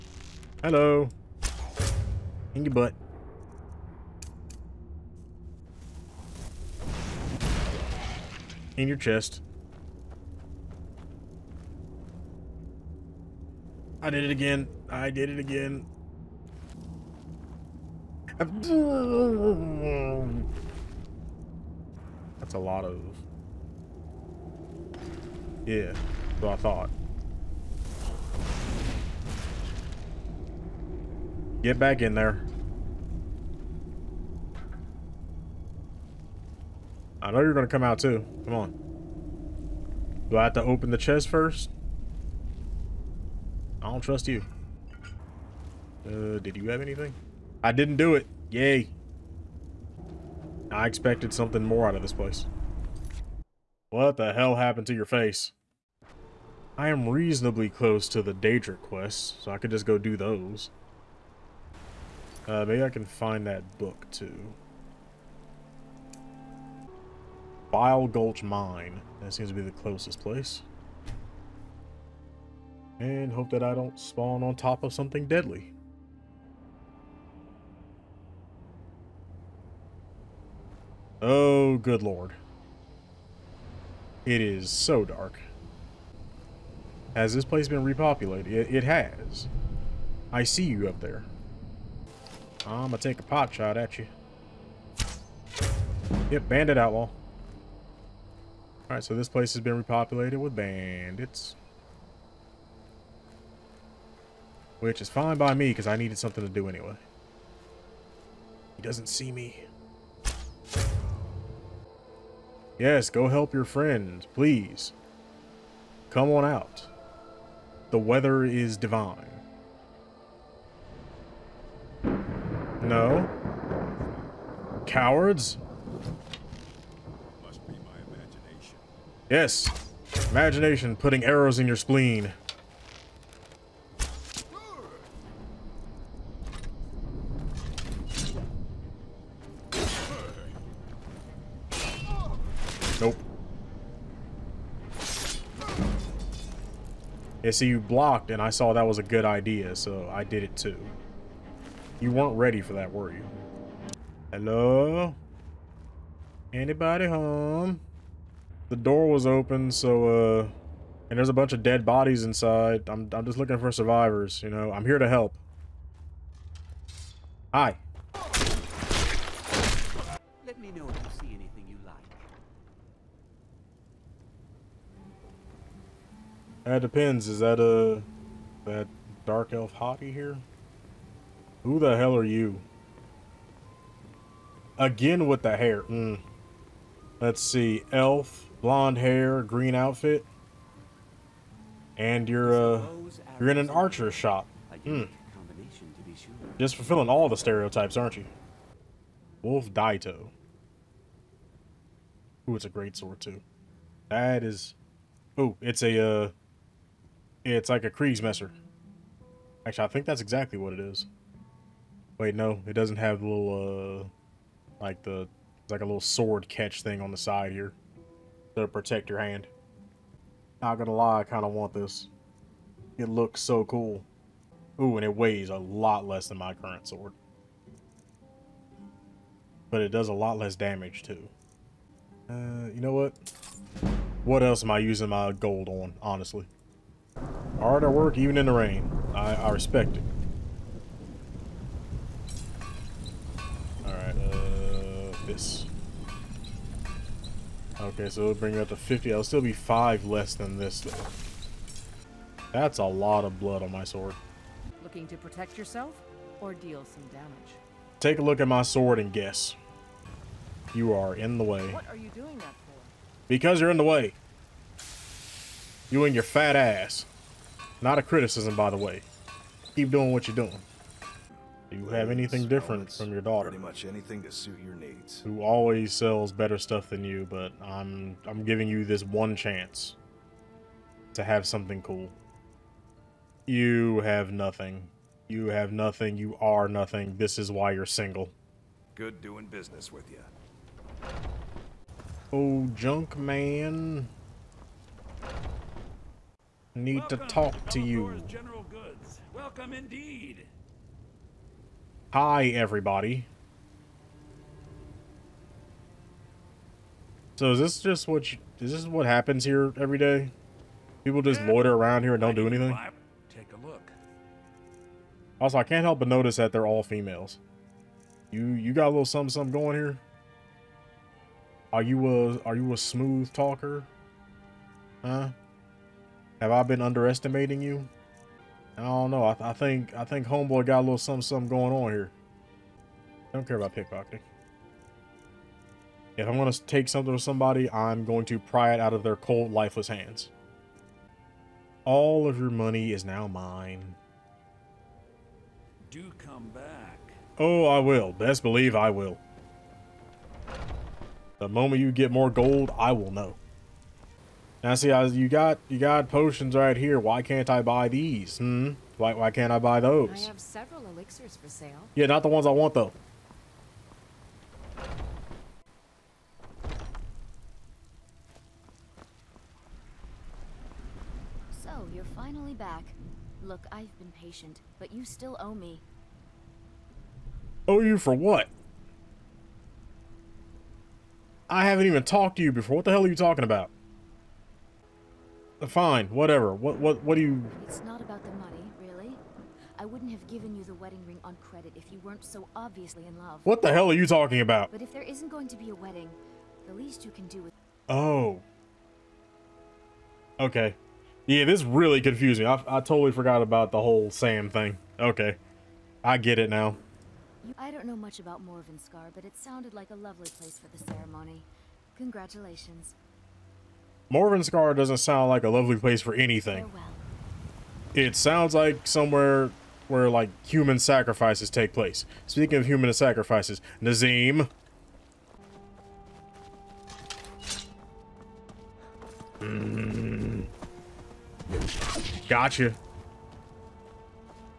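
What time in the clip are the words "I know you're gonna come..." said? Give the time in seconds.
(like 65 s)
37 s.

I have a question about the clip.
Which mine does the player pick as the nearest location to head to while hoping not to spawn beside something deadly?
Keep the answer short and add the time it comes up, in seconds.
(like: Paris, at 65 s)
Bile Gulch Mine, at 67 s.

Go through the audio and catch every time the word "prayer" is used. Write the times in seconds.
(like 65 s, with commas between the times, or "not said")
not said.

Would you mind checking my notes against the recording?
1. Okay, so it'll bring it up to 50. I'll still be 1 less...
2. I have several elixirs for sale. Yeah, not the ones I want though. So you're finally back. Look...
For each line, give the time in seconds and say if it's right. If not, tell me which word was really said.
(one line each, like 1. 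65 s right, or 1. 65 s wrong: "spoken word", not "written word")
1. 247 s wrong: "5", not "1"
2. 360 s right.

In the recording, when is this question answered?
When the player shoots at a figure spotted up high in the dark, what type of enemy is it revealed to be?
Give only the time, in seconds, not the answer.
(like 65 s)
96 s.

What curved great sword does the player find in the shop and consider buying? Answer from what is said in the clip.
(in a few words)
Wolf Daito.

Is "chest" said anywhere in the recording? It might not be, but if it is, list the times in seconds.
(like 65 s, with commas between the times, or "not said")
8 s, 40 s.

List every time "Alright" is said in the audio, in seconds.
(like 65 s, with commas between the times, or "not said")
98 s, 243 s.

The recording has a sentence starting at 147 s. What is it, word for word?
And so you blocked, and I saw that was a good idea, so I did it too.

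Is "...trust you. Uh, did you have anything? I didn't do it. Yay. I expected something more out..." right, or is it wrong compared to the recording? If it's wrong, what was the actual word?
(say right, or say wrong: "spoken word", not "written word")
right.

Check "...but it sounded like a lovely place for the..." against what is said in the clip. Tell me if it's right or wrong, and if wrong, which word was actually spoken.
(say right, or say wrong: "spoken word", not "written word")
right.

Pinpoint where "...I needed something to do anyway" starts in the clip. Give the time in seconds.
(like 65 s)
105 s.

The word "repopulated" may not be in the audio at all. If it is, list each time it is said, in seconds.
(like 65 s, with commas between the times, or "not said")
87 s, 99 s.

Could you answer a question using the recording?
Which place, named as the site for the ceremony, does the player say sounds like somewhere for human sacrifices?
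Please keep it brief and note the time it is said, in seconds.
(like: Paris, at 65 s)
Morvunskar, at 414 s.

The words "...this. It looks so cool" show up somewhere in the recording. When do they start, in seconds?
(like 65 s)
221 s.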